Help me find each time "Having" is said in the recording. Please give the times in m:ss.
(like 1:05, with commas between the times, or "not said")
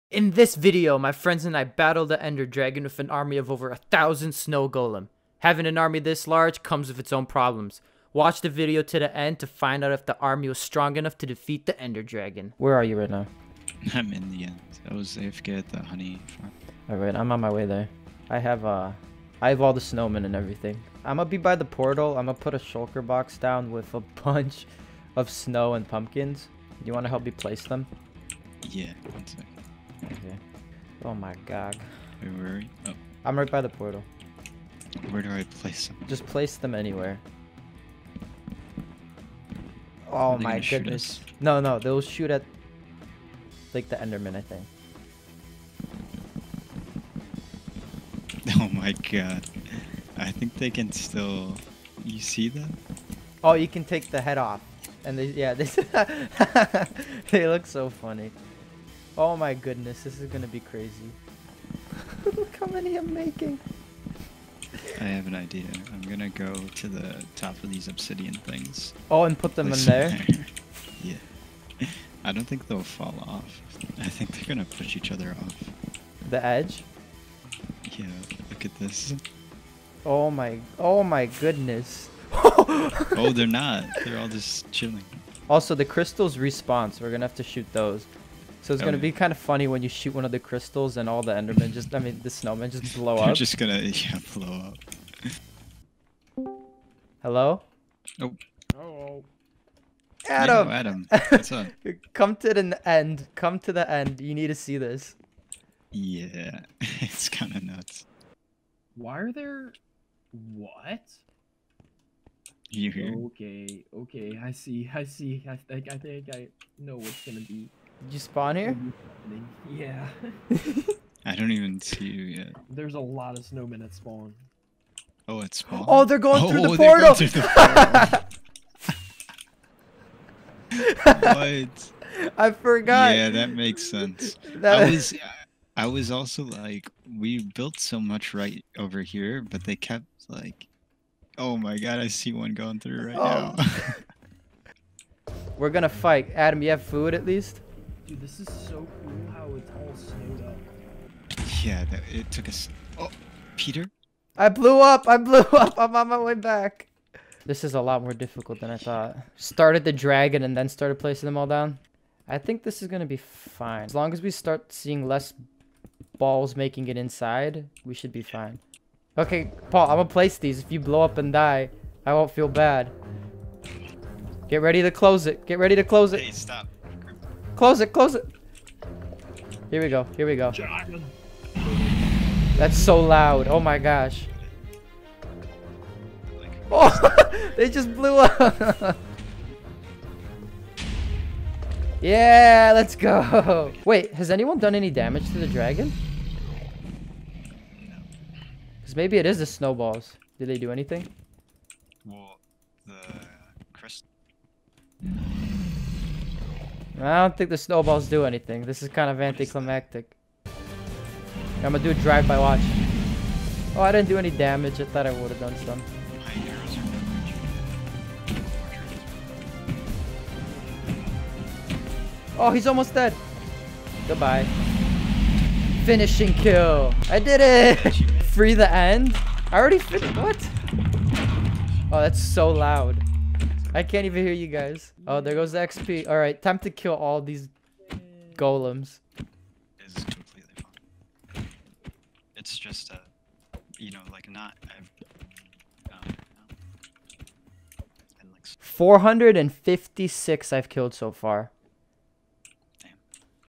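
0:05.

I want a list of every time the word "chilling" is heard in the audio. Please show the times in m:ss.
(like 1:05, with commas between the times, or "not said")
1:24.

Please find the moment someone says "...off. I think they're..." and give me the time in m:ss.
1:13.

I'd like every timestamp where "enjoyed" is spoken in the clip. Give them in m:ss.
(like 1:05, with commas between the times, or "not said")
not said.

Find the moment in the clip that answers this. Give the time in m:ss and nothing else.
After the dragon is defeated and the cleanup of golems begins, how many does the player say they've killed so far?
4:08.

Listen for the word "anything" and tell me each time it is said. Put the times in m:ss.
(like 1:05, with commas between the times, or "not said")
3:20, 3:28.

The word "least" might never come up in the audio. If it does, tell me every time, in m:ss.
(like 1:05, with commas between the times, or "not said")
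2:27.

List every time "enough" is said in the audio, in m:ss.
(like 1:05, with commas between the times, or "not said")
0:10.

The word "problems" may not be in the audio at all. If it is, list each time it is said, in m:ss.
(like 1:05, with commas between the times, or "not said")
0:07.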